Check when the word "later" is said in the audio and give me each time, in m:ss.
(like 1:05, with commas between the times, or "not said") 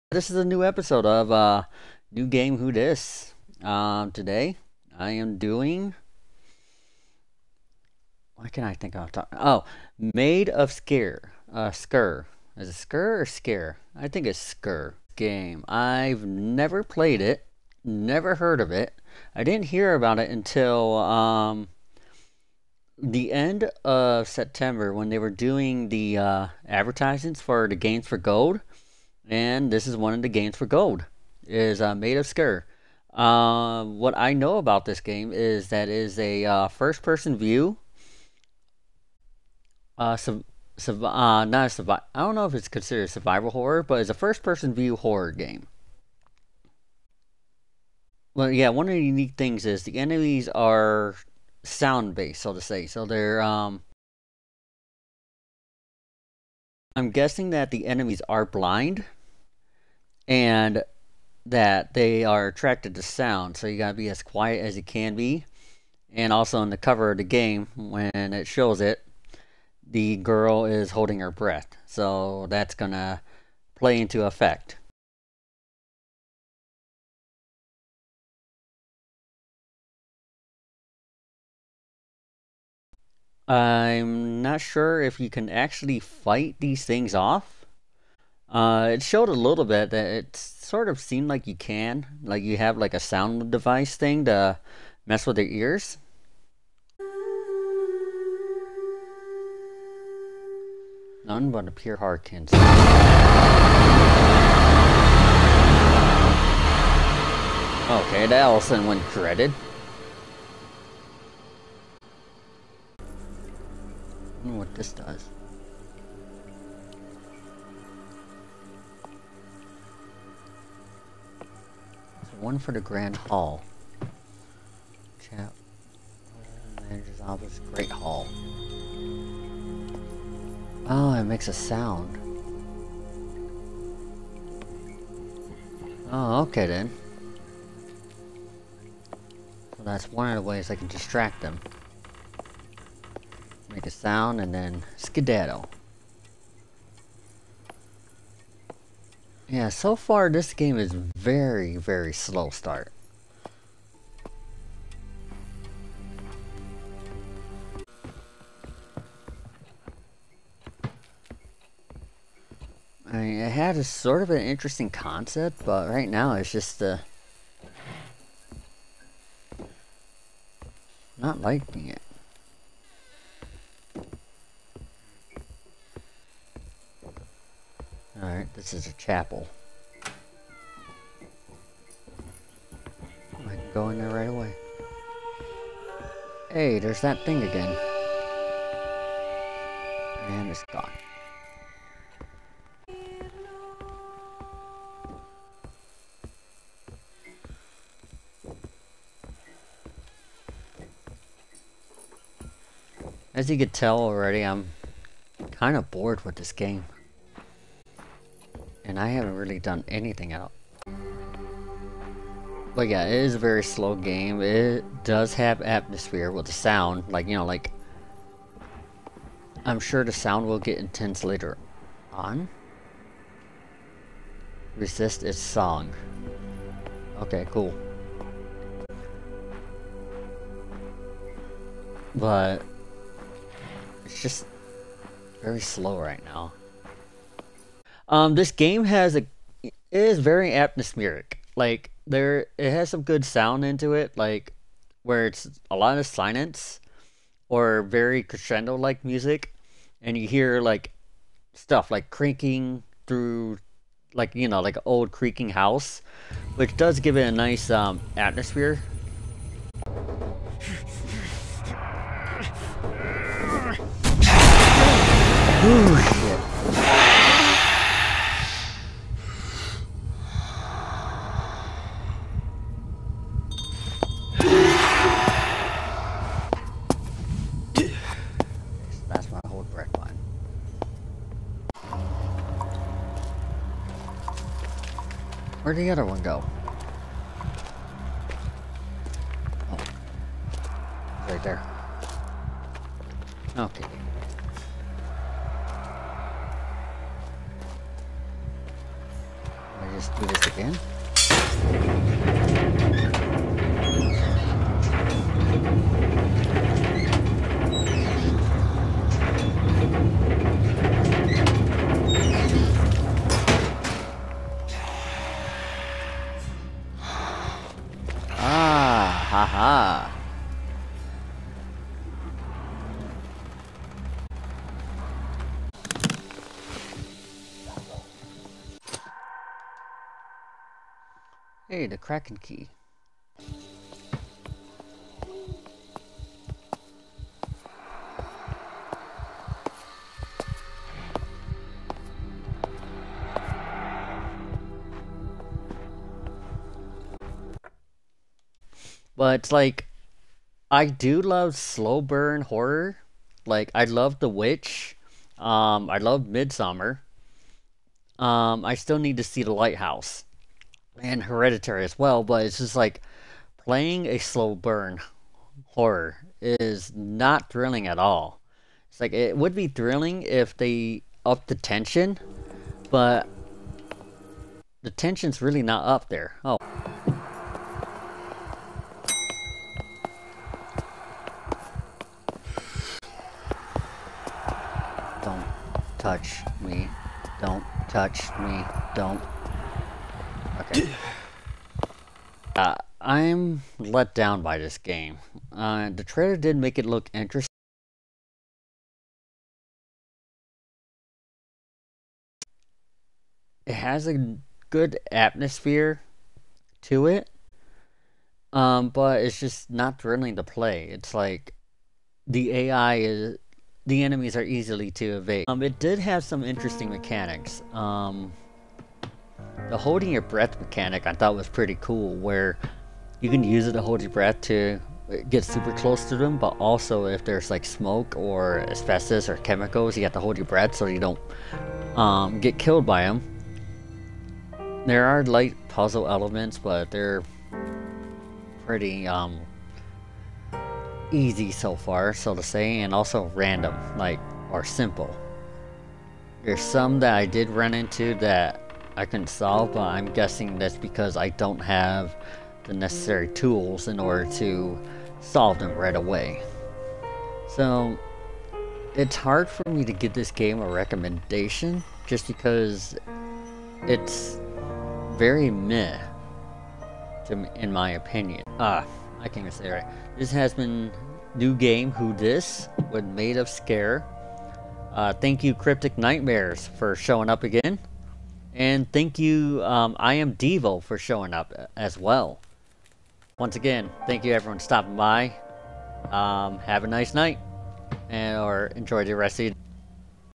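3:41.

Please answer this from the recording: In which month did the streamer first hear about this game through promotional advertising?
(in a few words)
September.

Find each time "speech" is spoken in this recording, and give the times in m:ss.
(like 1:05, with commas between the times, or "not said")
not said.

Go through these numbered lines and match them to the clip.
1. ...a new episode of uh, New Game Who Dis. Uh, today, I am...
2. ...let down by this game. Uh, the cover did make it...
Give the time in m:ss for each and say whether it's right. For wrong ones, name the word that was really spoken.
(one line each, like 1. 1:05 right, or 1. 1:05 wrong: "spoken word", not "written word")
1. 0:00 right
2. 6:33 wrong: "trailer", not "cover".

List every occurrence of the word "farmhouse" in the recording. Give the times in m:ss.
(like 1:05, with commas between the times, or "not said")
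not said.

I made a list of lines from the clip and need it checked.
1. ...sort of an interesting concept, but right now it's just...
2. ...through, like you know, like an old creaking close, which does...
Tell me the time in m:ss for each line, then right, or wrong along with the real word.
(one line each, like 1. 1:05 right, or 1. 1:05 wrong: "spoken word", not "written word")
1. 2:43 right
2. 4:13 wrong: "house", not "close".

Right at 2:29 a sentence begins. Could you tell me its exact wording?
Yeah, so far this game is very, very slow start.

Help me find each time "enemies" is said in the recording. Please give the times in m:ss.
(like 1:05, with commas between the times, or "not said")
0:49, 0:57, 6:54.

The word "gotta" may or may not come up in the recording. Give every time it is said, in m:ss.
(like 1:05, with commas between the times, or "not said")
1:03.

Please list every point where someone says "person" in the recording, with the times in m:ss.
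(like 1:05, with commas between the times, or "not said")
0:37, 0:44.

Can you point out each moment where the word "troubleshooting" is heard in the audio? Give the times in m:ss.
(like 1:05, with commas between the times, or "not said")
not said.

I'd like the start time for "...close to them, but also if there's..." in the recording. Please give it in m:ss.
7:05.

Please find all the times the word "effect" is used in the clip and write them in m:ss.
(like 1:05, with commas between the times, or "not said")
1:14.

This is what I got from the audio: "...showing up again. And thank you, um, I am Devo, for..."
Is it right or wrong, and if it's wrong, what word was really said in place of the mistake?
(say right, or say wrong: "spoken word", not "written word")
right.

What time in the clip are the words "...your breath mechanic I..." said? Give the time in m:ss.
7:00.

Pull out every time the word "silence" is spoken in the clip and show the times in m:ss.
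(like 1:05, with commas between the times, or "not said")
4:06.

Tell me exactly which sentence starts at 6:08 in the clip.
It's like it would be thrilling if they upped the tension, but the tension's really not up there.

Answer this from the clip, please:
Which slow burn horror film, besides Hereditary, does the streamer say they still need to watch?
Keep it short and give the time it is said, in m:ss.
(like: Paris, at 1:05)
The Lighthouse, at 5:59.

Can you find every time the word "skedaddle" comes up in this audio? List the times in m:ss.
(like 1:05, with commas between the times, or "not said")
2:24.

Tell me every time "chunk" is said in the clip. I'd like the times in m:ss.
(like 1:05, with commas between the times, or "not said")
not said.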